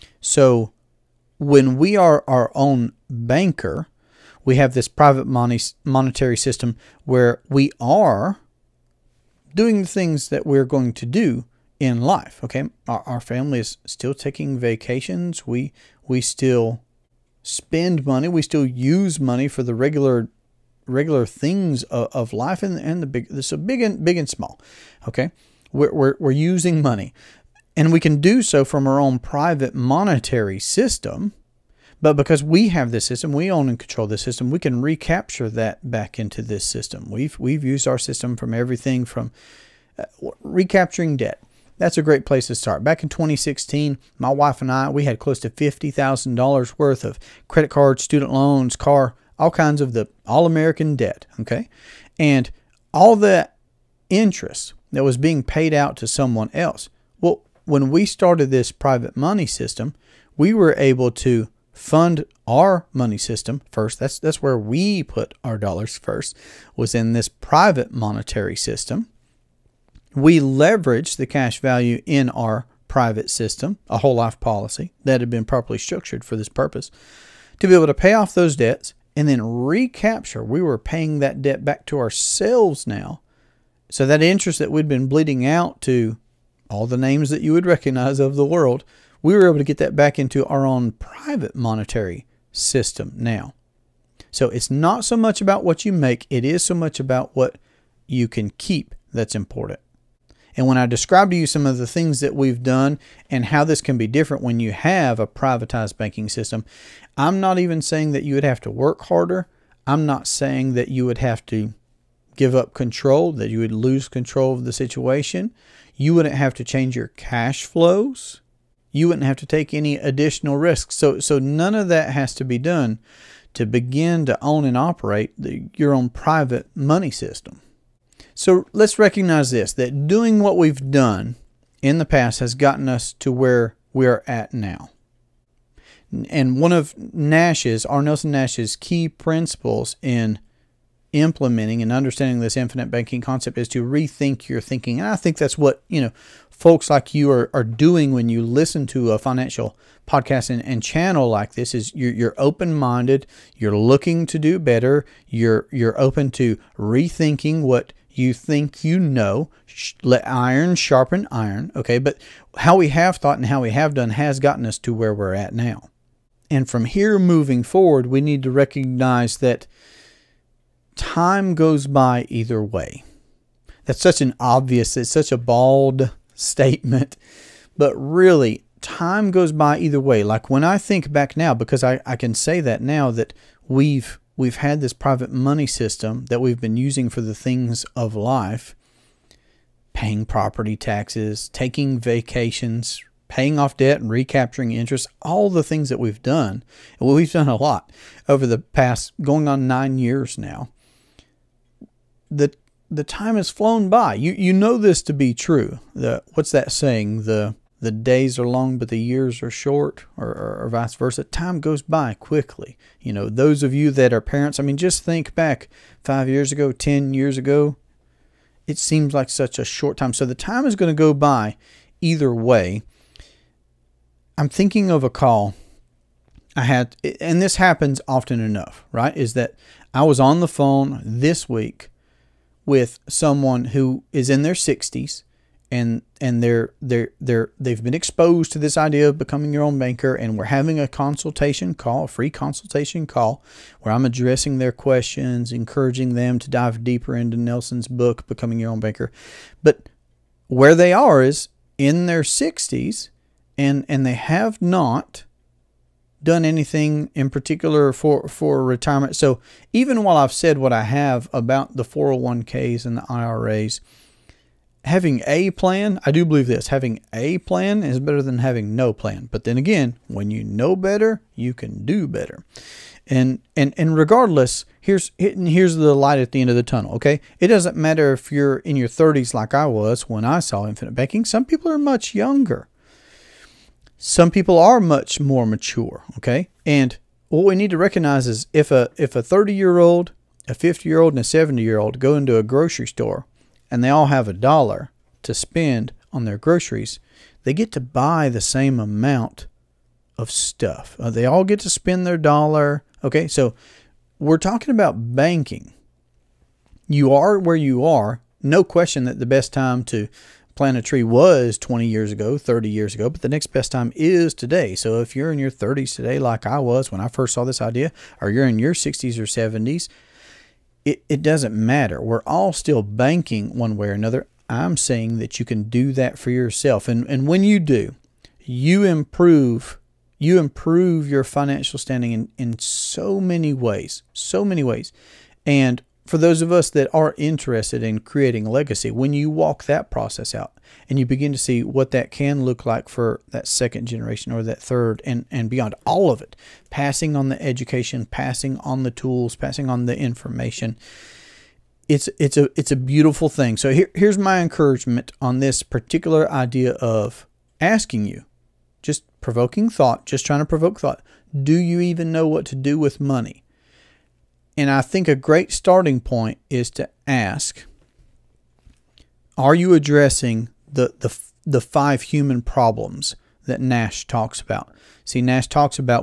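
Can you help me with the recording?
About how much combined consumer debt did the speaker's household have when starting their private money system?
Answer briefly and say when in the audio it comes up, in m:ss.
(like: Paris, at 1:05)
$50,000, at 0:45.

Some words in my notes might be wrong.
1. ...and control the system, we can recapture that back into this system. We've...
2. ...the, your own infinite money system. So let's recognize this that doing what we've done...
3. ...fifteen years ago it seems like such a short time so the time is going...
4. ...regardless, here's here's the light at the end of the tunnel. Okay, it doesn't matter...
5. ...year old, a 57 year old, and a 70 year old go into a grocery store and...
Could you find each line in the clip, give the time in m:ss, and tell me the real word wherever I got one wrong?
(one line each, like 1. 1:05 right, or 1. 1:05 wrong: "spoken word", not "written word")
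1. 0:33 right
2. 2:05 wrong: "private", not "infinite"
3. 3:36 wrong: "ten", not "fifteen"
4. 4:33 right
5. 4:49 wrong: "50", not "57".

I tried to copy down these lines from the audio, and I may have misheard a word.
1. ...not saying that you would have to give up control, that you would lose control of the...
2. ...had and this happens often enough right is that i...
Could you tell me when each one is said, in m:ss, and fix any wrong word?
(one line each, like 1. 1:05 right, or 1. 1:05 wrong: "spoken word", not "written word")
1. 1:50 right
2. 3:46 right.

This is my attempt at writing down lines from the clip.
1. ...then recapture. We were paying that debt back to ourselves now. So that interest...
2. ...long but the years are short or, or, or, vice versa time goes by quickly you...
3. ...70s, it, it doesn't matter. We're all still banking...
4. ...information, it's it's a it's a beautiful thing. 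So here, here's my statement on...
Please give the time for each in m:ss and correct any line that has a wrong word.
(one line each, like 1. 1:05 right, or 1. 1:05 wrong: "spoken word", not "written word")
1. 1:19 right
2. 3:28 right
3. 5:19 right
4. 5:49 wrong: "encouragement", not "statement".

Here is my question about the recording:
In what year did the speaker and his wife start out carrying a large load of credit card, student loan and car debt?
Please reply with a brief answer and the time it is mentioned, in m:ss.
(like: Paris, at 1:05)
2016, at 0:43.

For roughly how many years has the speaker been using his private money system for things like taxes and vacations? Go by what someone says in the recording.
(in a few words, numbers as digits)
9 years.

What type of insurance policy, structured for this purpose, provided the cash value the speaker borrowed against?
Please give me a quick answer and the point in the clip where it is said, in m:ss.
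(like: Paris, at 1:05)
whole life policy, at 1:13.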